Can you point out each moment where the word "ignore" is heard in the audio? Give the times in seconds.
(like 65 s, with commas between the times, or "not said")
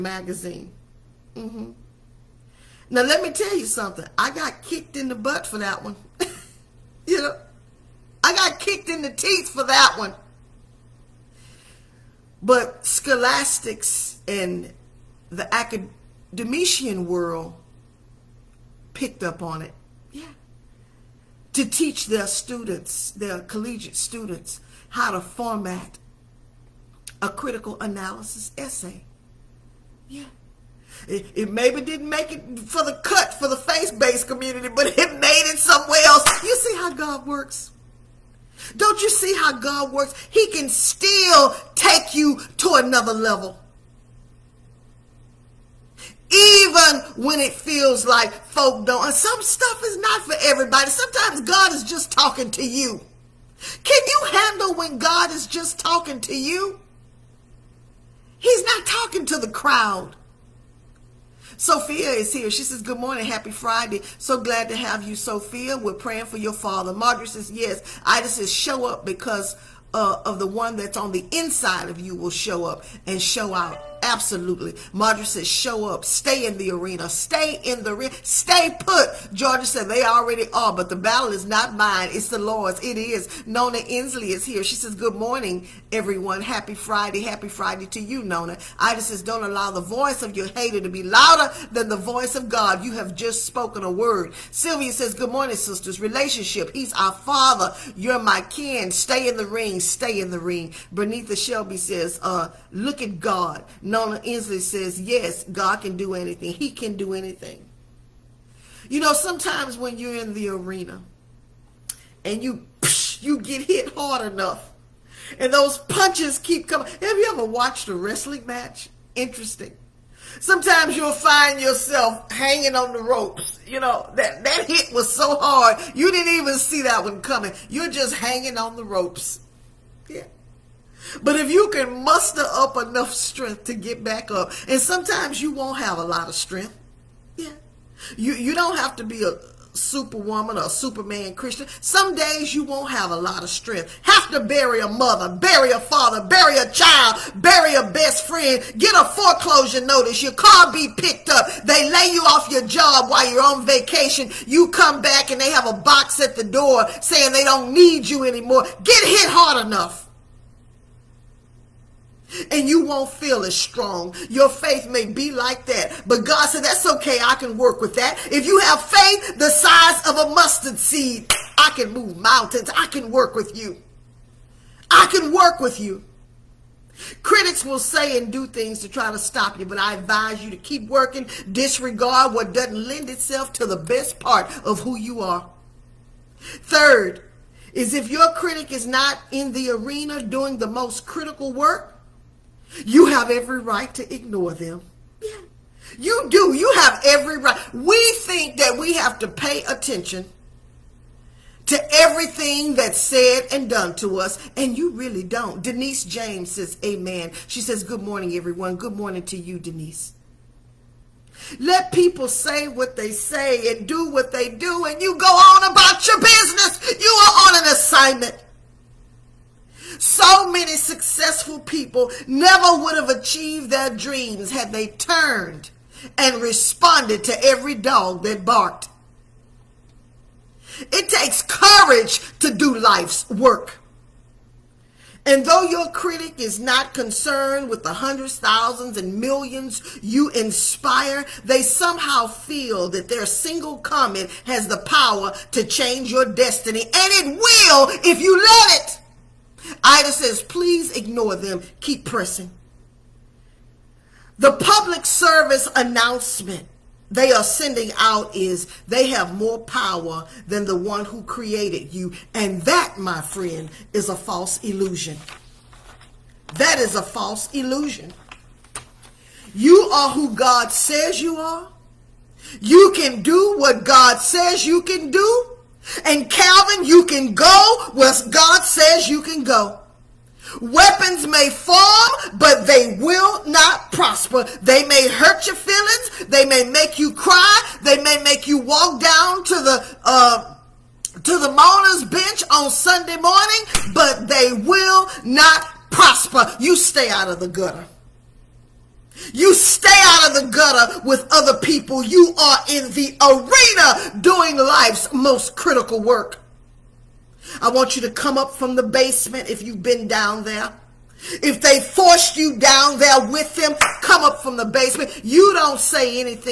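194 s, 250 s.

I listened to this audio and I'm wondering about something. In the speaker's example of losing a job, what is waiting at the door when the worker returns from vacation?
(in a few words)
A box.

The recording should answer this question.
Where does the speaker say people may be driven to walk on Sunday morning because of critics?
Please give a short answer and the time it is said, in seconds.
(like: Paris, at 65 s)
The mourner's bench, at 291 s.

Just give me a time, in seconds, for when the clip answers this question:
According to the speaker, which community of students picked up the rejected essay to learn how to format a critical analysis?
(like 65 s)
23 s.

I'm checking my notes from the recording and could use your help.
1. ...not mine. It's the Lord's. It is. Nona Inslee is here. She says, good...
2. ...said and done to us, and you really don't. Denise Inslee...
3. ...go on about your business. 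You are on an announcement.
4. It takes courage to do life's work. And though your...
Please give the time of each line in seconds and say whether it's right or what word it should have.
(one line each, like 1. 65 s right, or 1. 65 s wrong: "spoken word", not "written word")
1. 81 s right
2. 202 s wrong: "James", not "Inslee"
3. 215 s wrong: "assignment", not "announcement"
4. 230 s right.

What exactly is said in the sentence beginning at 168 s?
If you have faith the size of a mustard seed, I can move mountains.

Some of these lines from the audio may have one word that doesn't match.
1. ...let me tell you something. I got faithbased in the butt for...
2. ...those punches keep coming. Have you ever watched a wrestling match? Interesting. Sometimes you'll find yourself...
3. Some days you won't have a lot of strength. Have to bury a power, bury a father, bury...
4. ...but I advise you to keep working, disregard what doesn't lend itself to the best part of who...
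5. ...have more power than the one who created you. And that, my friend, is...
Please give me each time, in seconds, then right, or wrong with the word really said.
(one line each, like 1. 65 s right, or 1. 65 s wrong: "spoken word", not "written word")
1. 3 s wrong: "kicked", not "faithbased"
2. 115 s right
3. 141 s wrong: "mother", not "power"
4. 179 s right
5. 259 s right.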